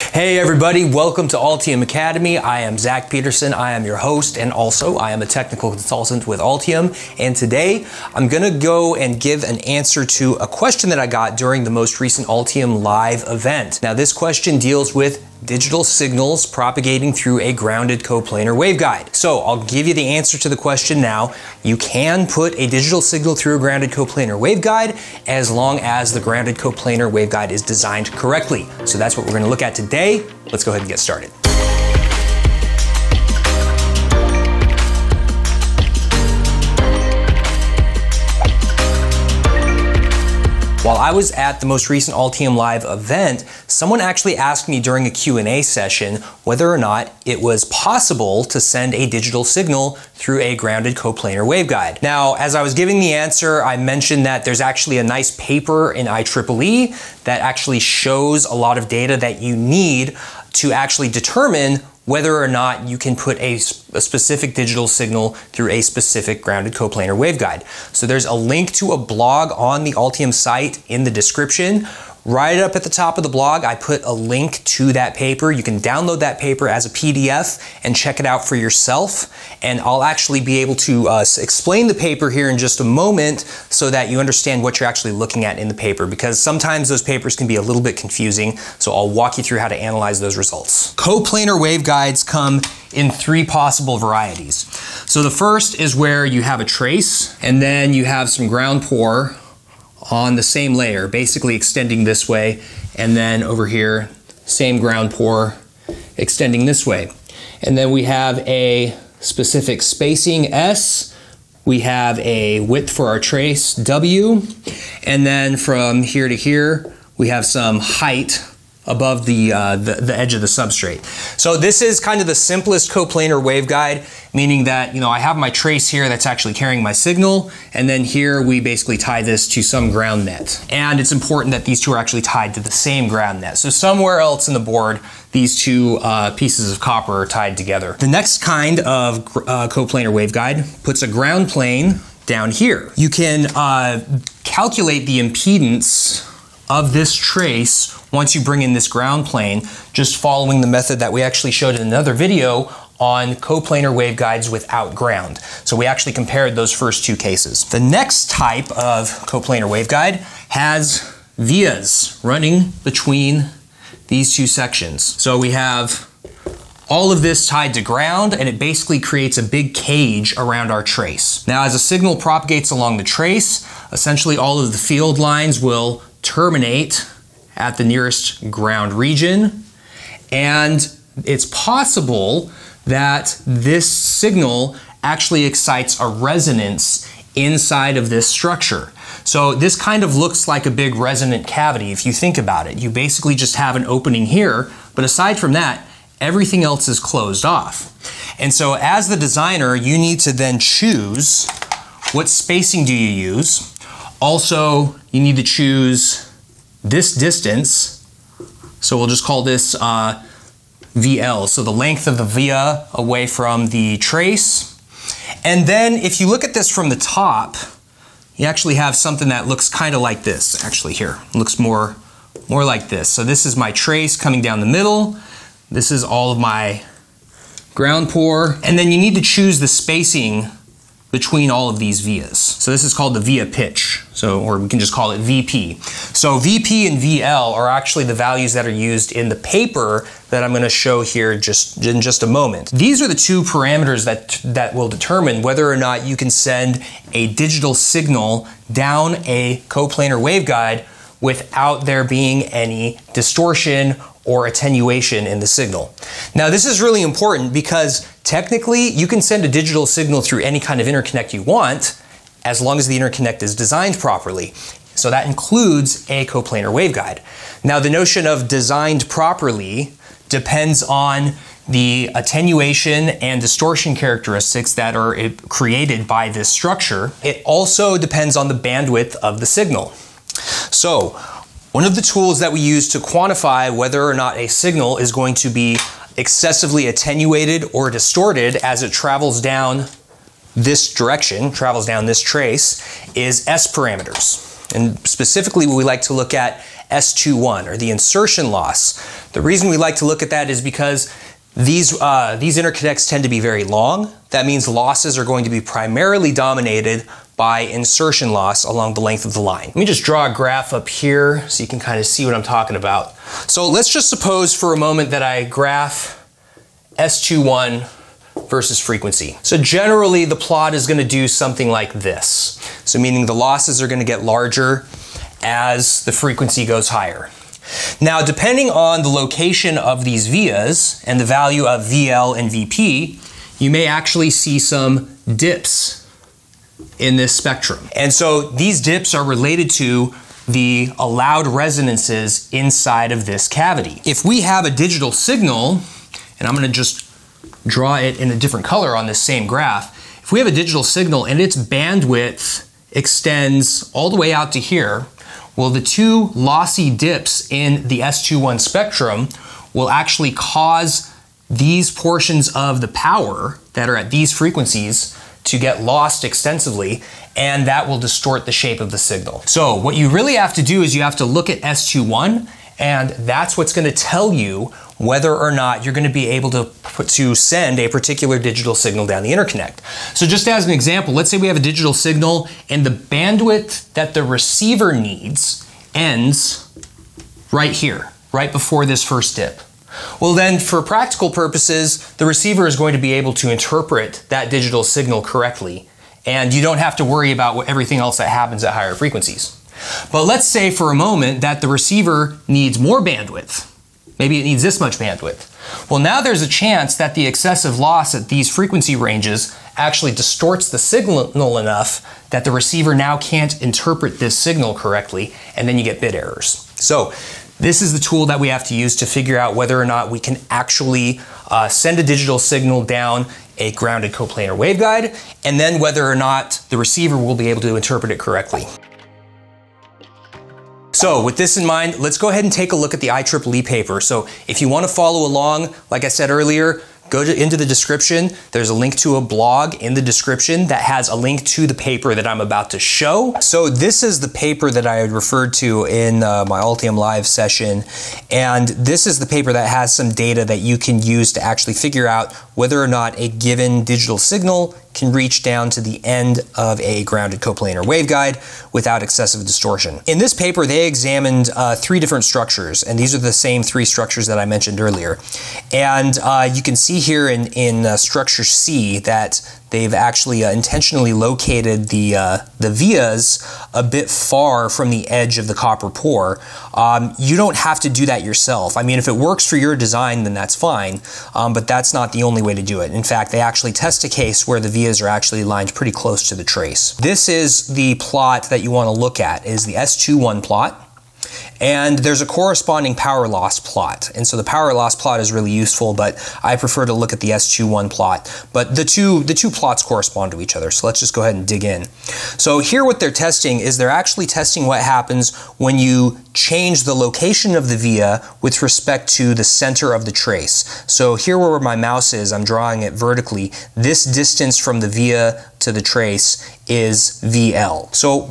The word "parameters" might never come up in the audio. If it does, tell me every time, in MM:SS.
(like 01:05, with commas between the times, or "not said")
04:03, 04:53.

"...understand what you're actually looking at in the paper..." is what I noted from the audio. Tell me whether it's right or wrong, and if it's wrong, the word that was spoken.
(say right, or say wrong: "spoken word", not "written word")
right.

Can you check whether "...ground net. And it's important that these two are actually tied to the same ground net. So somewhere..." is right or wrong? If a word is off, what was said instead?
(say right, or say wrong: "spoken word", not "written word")
right.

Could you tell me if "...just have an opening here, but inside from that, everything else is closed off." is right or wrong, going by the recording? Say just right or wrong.
wrong.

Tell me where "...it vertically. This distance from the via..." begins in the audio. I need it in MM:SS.
08:32.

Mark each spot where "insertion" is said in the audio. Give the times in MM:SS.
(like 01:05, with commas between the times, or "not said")
04:57, 05:07.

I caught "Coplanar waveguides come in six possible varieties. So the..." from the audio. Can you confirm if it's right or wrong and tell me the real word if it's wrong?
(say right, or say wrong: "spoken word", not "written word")
wrong: "three", not "six".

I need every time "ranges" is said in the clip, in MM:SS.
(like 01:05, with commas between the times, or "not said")
06:48.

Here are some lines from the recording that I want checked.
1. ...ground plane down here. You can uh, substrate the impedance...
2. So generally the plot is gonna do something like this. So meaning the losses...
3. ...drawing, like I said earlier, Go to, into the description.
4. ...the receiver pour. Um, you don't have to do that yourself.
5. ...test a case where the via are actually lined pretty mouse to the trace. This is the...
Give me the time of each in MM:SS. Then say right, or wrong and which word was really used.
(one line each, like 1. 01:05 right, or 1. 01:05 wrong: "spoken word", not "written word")
1. 02:21 wrong: "calculate", not "substrate"
2. 05:19 right
3. 07:15 wrong: "along", not "drawing"
4. 07:55 wrong: "copper", not "receiver"
5. 08:03 wrong: "close", not "mouse".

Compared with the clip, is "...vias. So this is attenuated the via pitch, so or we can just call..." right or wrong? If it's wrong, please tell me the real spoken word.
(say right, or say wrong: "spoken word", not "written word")
wrong: "called", not "attenuated".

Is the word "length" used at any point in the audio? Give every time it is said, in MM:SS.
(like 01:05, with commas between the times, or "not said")
03:31, 05:08.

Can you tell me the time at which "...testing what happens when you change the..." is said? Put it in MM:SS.
08:24.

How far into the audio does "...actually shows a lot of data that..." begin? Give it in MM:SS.
00:57.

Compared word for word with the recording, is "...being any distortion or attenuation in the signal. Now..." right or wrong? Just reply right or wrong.
right.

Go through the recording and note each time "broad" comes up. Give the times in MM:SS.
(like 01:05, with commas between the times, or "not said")
not said.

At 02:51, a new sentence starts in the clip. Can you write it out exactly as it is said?
Now as a signal propagates along the trace, essentially all of the field lines will terminate at the nearest ground region.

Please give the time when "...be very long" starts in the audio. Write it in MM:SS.
05:03.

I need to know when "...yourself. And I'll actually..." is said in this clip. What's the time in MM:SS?
01:18.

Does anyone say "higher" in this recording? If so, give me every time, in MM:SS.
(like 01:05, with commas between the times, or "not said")
05:26, 06:38.